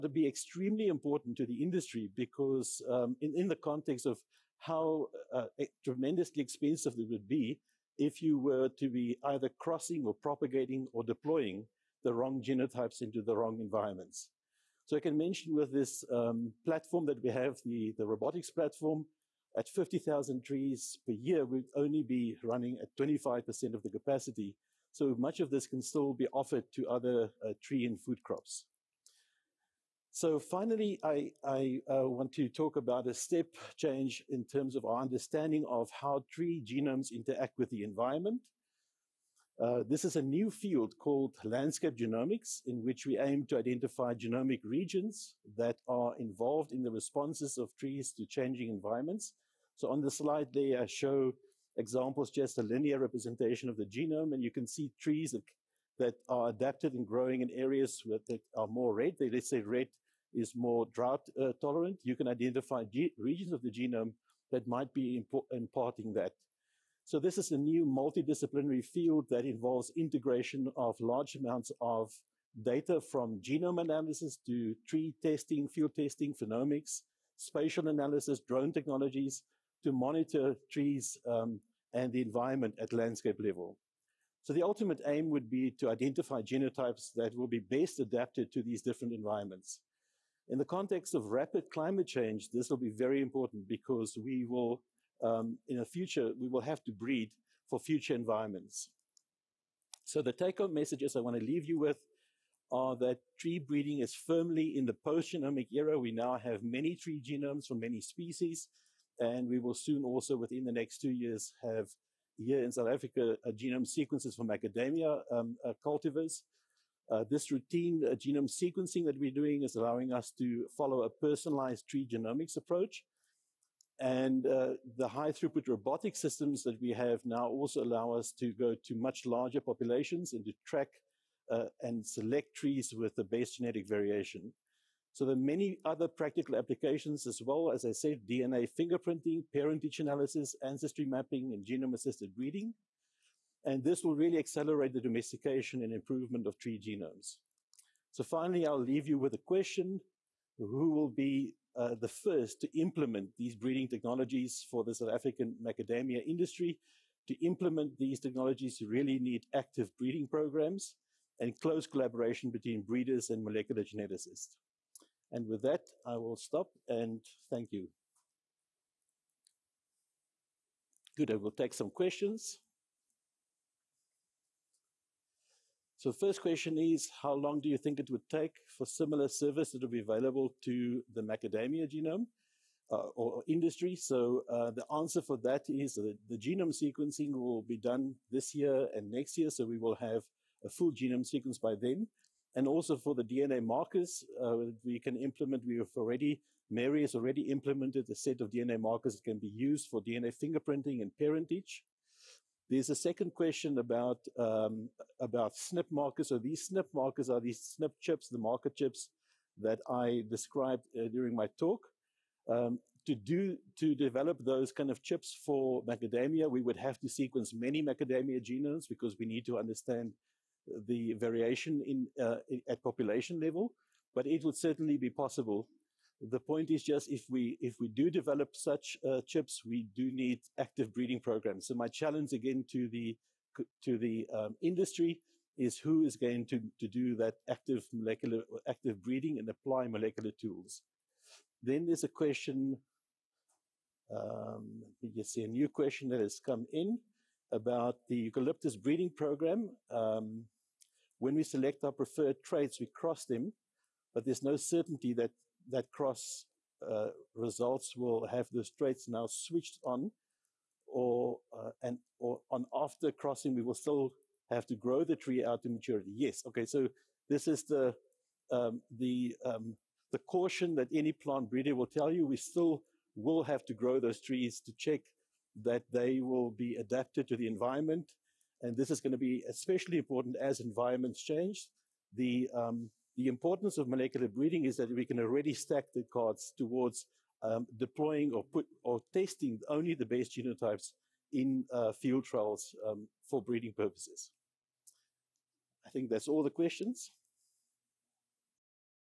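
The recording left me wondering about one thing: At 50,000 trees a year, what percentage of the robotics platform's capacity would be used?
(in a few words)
25%.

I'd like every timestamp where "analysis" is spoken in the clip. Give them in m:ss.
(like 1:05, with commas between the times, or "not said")
1:13, 1:17, 2:19.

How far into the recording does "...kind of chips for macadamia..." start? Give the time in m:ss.
3:34.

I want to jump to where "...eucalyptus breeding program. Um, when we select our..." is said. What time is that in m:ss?
4:08.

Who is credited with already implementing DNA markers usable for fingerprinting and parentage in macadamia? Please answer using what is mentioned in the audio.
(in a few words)
Mary.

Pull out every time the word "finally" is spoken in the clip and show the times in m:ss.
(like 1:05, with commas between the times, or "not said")
0:30, 2:28.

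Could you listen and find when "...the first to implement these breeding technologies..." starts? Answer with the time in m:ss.
2:31.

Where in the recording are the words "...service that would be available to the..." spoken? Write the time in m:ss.
2:59.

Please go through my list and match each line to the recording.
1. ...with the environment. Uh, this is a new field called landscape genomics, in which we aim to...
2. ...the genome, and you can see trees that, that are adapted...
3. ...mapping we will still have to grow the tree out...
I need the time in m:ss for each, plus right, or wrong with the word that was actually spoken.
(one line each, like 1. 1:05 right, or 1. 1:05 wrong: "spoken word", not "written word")
1. 0:37 right
2. 0:53 right
3. 4:23 wrong: "crossing", not "mapping".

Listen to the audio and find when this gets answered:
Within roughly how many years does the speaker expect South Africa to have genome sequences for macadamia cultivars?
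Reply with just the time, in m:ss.
1:51.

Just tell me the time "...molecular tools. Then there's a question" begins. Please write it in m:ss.
3:59.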